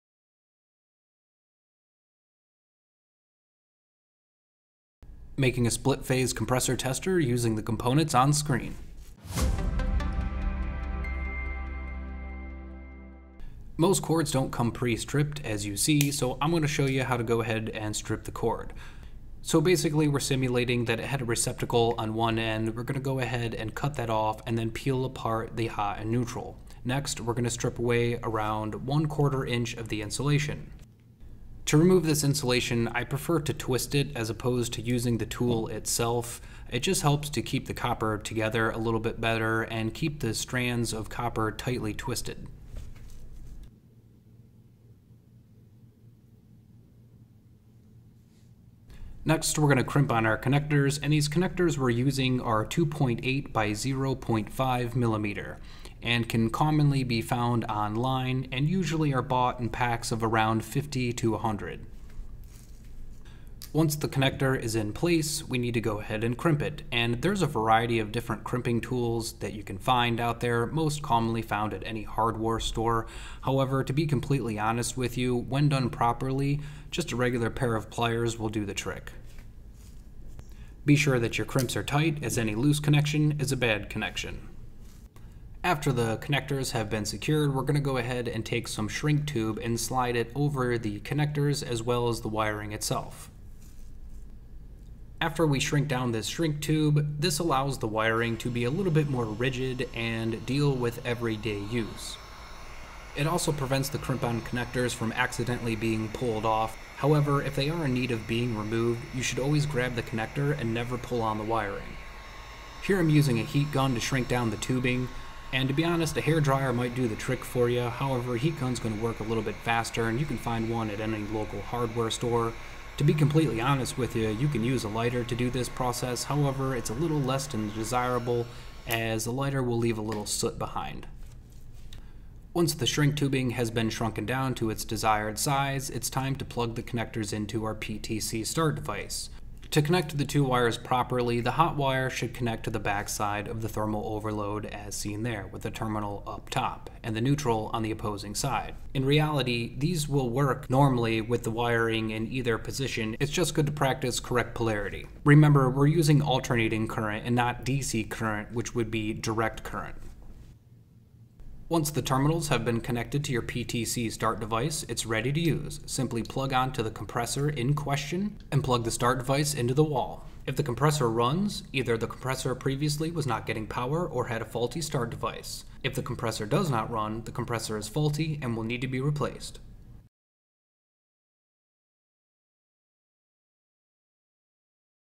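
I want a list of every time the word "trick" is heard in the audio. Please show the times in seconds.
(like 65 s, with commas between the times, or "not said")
78 s, 117 s.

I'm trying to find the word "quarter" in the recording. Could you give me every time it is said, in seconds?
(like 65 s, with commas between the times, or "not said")
29 s.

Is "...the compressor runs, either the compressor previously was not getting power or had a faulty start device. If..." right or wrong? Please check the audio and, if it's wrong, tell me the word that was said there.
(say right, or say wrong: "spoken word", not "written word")
right.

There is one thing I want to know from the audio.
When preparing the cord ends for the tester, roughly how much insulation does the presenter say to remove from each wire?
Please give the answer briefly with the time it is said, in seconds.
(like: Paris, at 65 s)
1/4 inch, at 28 s.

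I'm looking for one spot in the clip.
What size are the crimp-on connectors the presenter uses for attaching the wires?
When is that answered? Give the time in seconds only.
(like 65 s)
52 s.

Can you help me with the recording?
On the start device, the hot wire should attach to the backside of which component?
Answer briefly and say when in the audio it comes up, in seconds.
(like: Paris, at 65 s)
thermal overload, at 143 s.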